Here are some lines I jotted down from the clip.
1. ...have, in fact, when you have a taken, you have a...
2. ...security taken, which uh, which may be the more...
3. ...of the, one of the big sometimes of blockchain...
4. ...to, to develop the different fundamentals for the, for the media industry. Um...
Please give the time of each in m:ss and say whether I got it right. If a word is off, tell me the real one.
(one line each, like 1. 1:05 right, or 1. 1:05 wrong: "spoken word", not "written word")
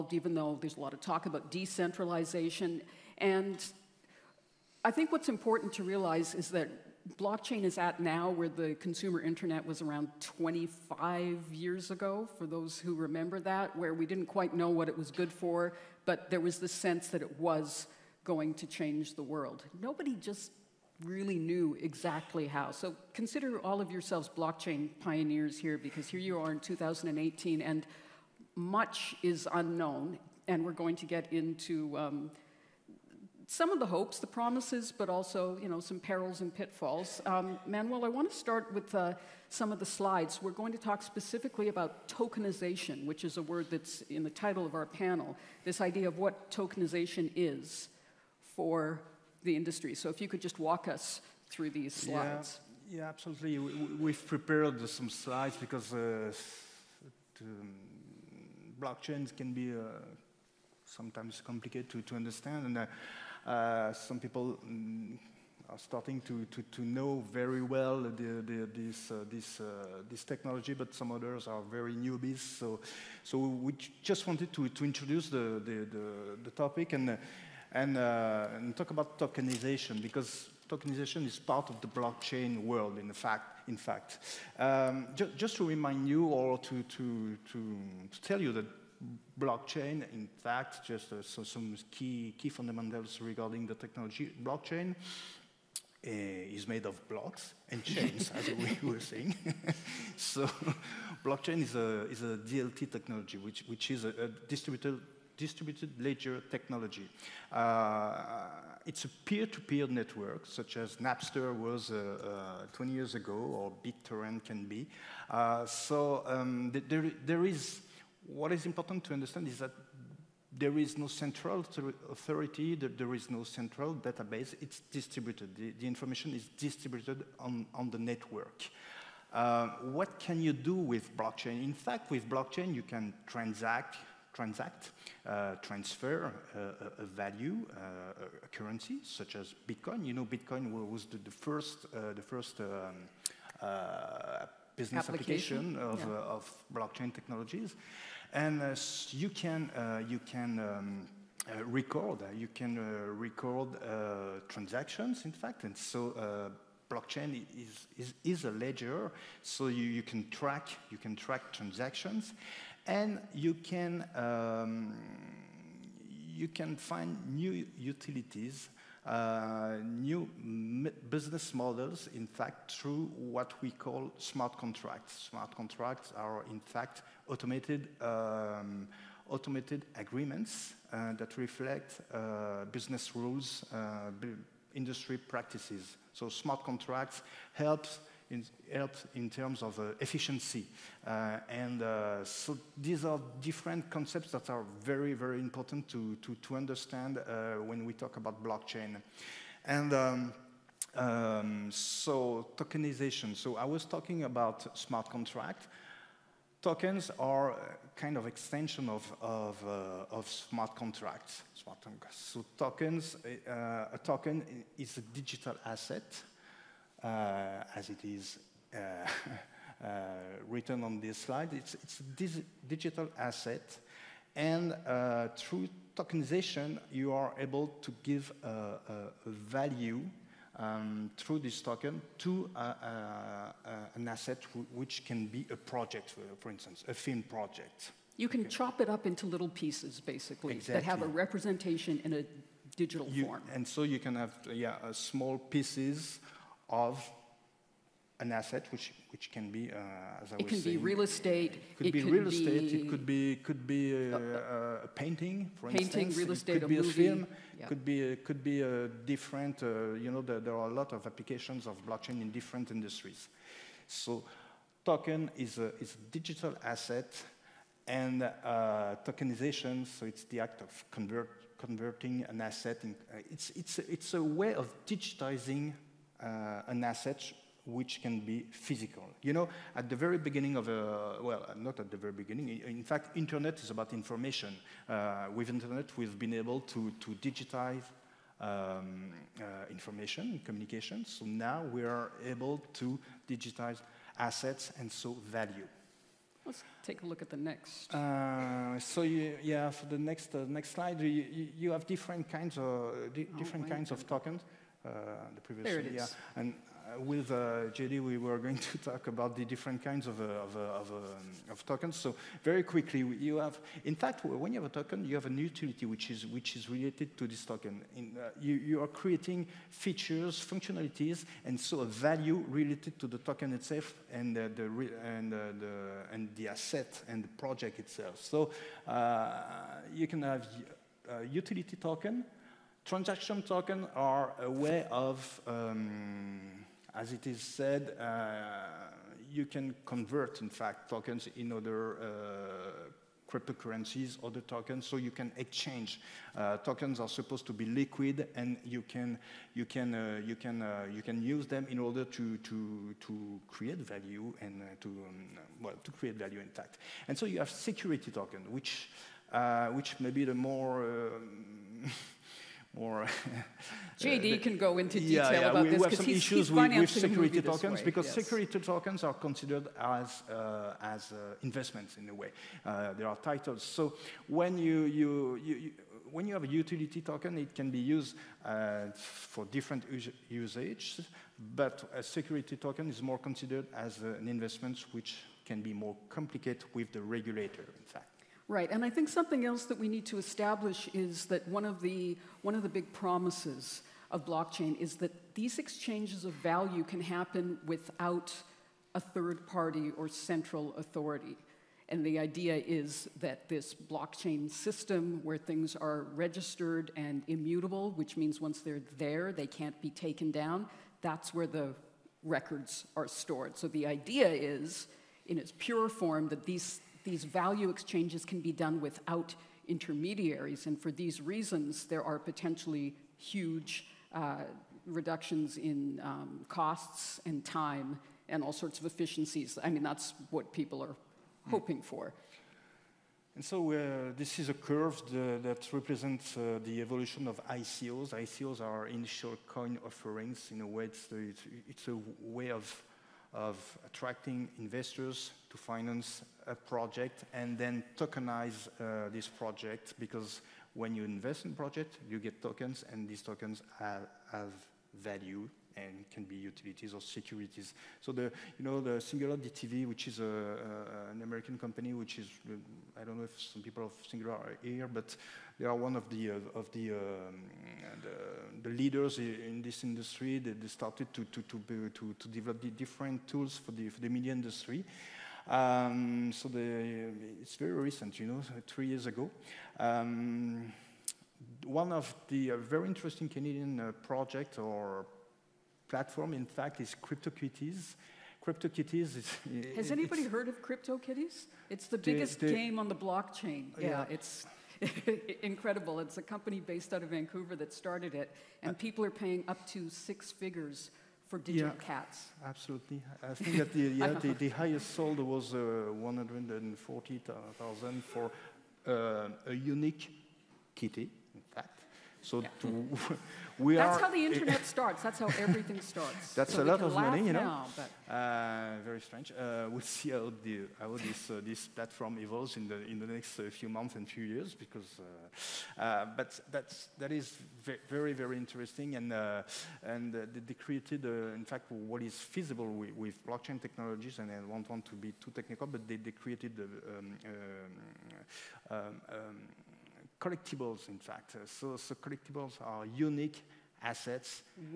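1. 5:13 wrong: "token", not "taken"
2. 5:57 wrong: "token", not "taken"
3. 6:31 wrong: "promises", not "sometimes"
4. 7:51 wrong: "tools", not "fundamentals".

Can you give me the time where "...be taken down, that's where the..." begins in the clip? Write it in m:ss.
6:49.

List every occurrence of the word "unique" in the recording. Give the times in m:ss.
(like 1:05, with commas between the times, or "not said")
8:29, 9:02.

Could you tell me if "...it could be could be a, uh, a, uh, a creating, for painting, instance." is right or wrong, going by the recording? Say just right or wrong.
wrong.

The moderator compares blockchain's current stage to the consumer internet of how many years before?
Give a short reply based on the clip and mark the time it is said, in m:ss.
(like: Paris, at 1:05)
25 years, at 0:10.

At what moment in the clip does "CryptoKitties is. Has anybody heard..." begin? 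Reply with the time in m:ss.
8:08.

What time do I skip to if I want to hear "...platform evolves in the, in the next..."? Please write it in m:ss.
8:41.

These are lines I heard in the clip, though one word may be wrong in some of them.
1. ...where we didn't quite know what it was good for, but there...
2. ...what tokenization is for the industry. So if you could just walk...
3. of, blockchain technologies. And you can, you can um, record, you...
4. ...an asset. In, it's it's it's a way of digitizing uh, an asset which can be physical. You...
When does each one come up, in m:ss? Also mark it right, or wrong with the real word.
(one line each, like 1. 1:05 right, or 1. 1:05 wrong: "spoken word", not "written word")
1. 0:13 right
2. 0:46 right
3. 2:26 right
4. 4:32 right.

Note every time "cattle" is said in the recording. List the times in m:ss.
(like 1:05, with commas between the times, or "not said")
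not said.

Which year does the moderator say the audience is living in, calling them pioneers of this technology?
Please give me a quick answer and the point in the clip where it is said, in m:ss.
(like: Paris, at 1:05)
2018, at 0:26.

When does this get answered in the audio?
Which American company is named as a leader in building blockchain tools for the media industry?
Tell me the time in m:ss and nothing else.
7:39.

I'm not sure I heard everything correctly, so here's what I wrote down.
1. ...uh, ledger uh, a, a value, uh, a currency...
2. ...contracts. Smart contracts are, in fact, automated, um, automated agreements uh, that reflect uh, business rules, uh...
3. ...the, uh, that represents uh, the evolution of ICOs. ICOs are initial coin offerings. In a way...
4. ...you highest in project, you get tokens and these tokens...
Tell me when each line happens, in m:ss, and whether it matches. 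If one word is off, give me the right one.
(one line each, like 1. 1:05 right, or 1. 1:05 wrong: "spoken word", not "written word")
1. 2:15 wrong: "transfer", not "ledger"
2. 2:54 right
3. 7:15 right
4. 7:30 wrong: "invest", not "highest".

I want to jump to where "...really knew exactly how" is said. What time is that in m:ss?
0:21.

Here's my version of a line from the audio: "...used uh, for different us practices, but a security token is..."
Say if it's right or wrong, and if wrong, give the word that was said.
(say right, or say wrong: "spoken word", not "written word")
wrong: "usages", not "practices".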